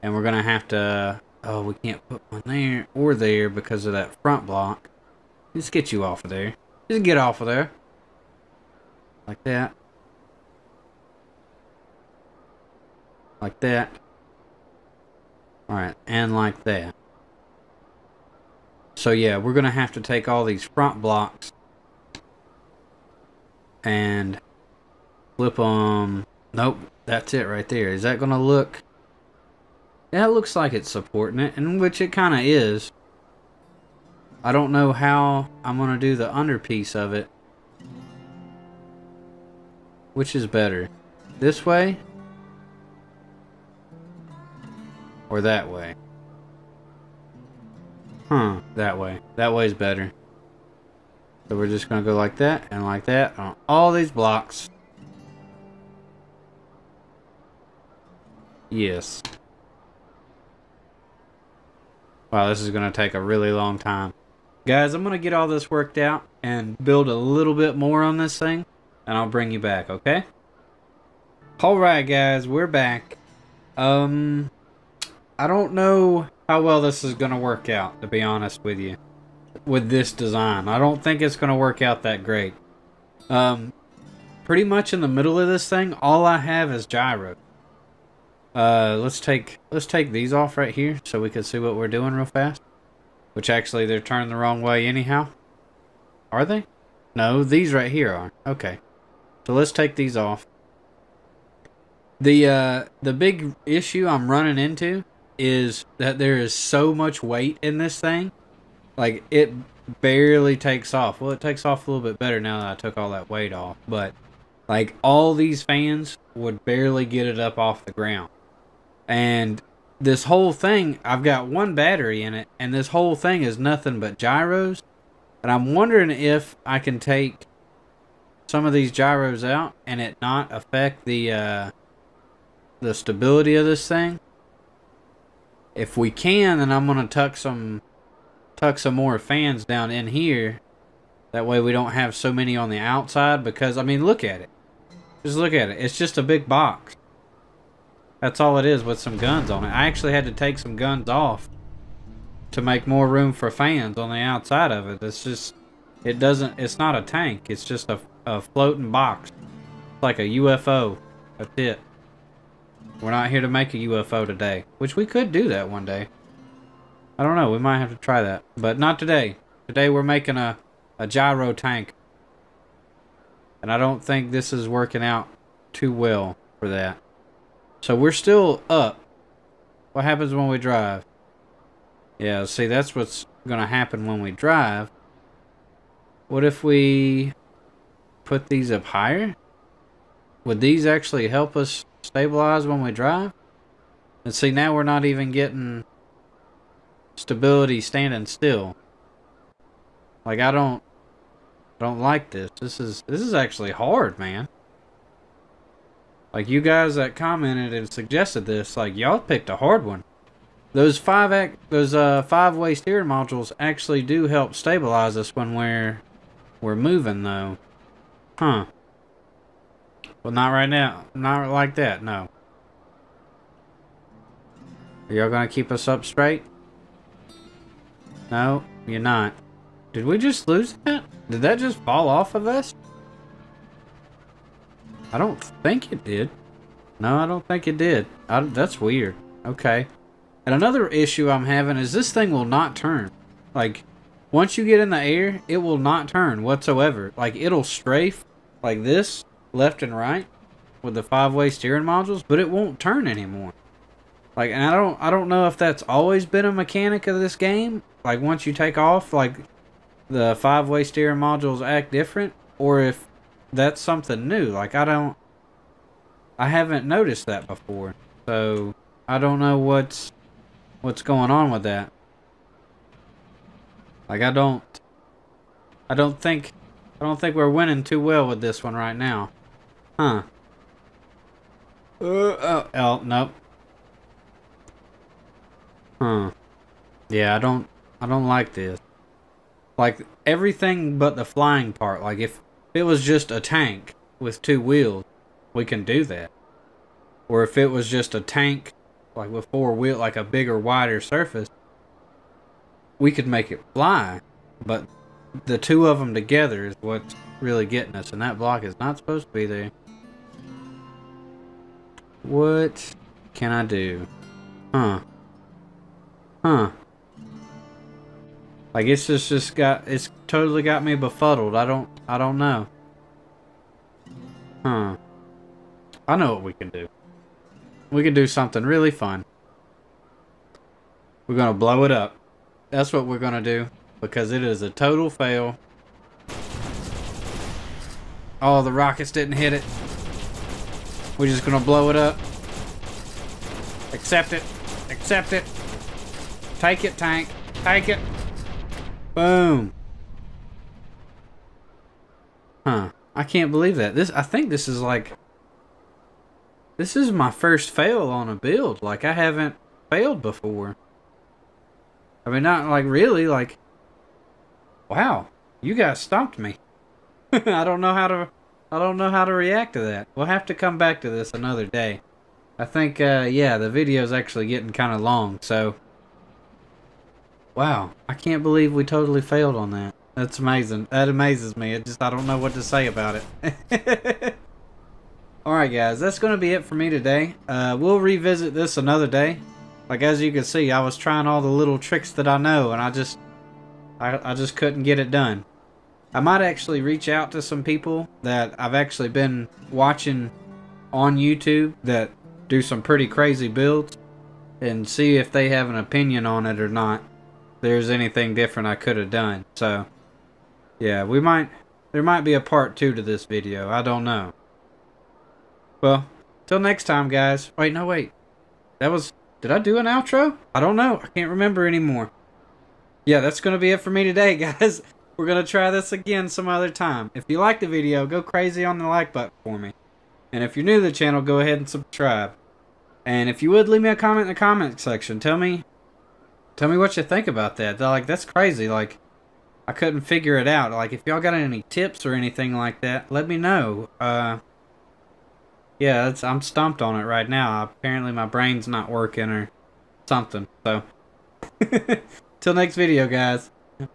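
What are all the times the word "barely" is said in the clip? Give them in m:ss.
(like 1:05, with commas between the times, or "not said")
1:50, 1:56.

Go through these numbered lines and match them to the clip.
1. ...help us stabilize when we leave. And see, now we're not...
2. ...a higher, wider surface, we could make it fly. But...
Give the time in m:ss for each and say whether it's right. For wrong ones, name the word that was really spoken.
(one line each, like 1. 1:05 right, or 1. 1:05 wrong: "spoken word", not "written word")
1. 3:11 wrong: "drive", not "leave"
2. 5:00 wrong: "bigger", not "higher".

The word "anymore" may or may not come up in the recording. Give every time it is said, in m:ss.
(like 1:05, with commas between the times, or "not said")
4:13, 7:01.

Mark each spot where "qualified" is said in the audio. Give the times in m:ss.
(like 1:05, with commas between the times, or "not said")
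not said.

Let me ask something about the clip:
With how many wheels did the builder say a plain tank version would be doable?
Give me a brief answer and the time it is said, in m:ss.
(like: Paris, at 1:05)
2, at 4:54.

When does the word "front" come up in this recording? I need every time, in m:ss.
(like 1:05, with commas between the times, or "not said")
0:04, 0:20.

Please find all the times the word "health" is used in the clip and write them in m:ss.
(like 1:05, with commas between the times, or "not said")
not said.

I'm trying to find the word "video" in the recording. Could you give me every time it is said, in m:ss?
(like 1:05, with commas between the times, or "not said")
6:13, 6:53, 7:07, 7:32.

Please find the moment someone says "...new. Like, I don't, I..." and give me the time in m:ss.
4:24.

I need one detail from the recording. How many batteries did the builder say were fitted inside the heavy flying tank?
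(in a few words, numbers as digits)
1.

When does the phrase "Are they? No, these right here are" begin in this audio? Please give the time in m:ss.
1:36.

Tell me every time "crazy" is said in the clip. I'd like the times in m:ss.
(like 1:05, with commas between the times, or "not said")
6:43, 7:08, 7:18.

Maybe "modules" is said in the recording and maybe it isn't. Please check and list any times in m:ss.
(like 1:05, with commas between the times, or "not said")
3:33, 4:11, 4:21.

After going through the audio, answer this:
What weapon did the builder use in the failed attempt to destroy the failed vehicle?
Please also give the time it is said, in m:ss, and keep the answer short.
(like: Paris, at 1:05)
Rockets, at 5:38.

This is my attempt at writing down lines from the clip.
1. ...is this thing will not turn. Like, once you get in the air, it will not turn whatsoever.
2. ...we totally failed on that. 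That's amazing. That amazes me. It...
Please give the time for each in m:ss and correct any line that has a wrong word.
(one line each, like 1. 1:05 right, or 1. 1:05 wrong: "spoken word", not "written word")
1. 4:01 right
2. 6:18 right.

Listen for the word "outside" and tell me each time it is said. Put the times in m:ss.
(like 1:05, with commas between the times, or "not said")
2:22, 2:34.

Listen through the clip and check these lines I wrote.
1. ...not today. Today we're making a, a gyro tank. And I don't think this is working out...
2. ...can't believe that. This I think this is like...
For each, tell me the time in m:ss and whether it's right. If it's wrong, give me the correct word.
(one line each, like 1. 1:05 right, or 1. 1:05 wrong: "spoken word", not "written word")
1. 2:48 right
2. 5:53 right.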